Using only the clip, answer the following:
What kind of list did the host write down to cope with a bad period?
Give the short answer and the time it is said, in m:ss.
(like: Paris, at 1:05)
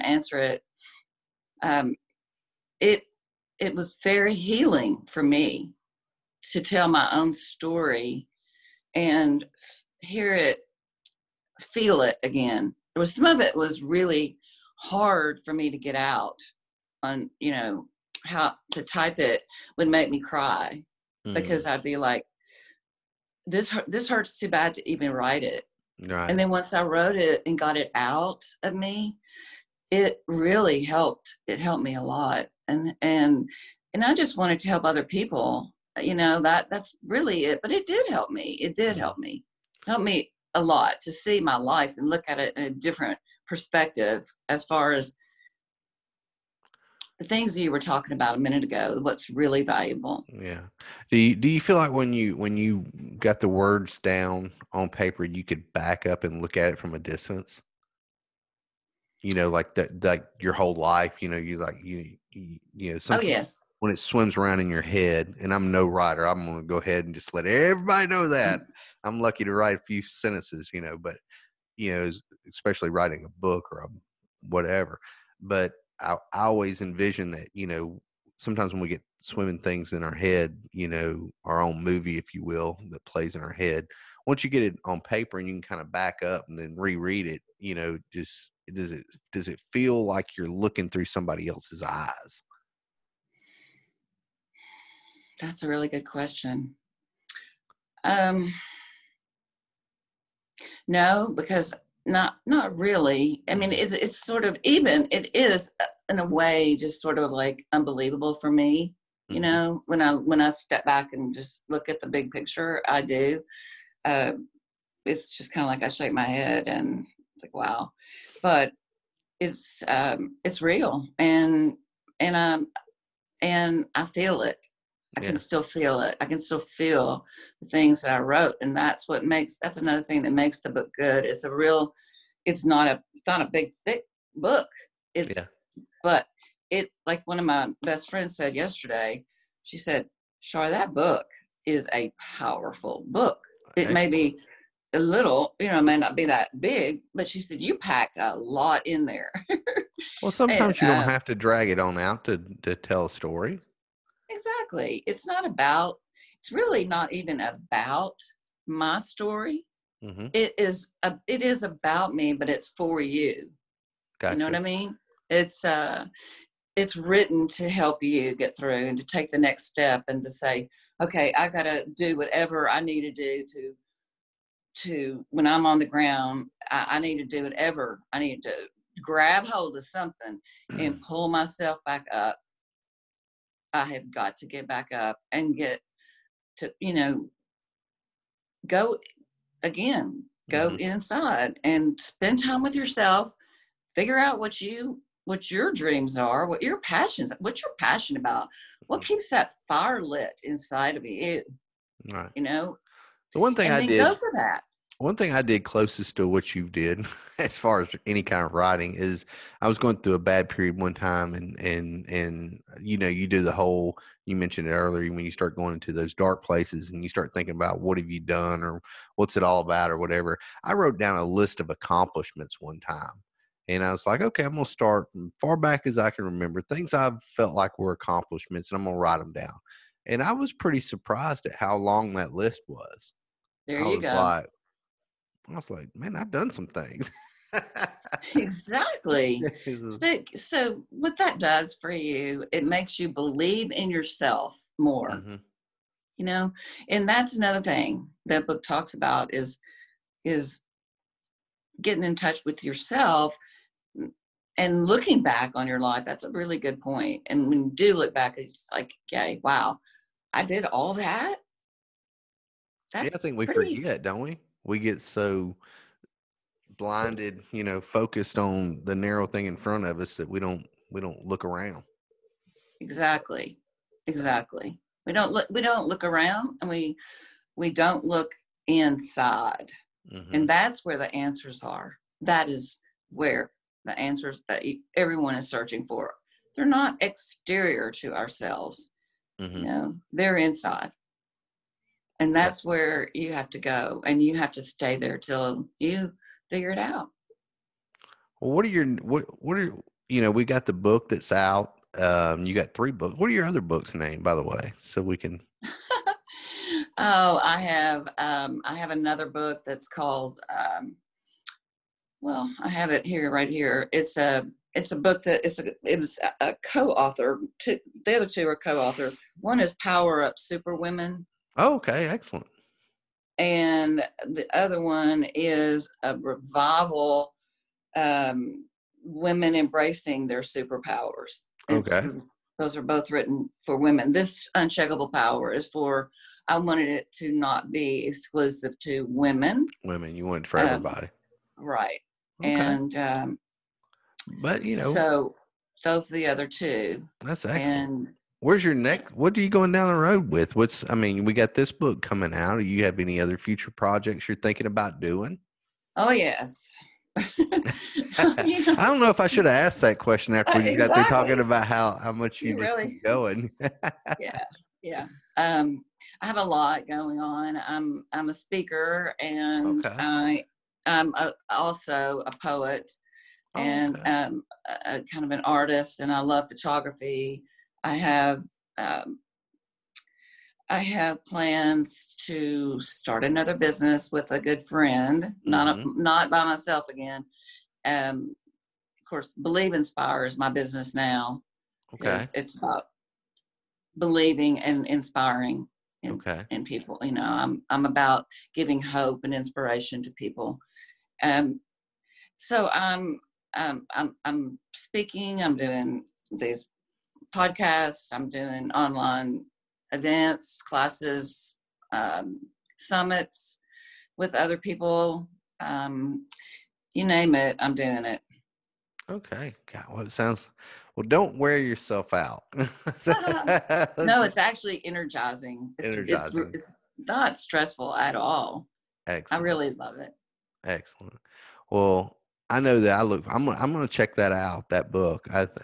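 list of accomplishments, at 3:41.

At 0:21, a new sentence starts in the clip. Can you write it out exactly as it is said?
because I'd be like, this this hurts too bad to even write it.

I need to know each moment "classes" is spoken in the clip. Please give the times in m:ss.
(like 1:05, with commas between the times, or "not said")
6:50.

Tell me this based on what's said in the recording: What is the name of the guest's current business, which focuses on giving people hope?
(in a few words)
Believe Inspire.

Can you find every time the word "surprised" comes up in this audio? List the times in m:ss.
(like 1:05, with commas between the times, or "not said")
3:50.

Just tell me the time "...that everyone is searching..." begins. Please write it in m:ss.
4:44.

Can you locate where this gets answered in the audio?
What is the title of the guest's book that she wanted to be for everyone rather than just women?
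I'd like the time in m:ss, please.
5:34.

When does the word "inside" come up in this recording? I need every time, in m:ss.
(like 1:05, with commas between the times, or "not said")
3:10, 3:20, 4:38, 4:50.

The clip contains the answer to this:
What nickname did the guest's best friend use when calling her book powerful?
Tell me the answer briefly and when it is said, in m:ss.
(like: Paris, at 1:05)
Char, at 2:20.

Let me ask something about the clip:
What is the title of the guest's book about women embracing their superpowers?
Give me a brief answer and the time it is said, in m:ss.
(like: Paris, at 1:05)
Revival, at 5:26.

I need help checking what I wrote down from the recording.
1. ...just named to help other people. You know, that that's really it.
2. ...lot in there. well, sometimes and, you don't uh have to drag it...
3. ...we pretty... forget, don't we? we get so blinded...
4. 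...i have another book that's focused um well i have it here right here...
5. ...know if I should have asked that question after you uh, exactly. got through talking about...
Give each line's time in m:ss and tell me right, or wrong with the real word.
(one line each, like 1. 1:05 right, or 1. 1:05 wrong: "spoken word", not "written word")
1. 0:34 wrong: "wanted", not "named"
2. 2:28 right
3. 4:23 right
4. 5:08 wrong: "called", not "focused"
5. 5:59 right.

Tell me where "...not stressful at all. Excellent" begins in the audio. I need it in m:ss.
7:06.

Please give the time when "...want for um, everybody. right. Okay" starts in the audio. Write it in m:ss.
5:40.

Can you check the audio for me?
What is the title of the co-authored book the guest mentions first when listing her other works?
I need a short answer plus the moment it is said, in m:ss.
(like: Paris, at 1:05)
Power Up Super Women, at 5:19.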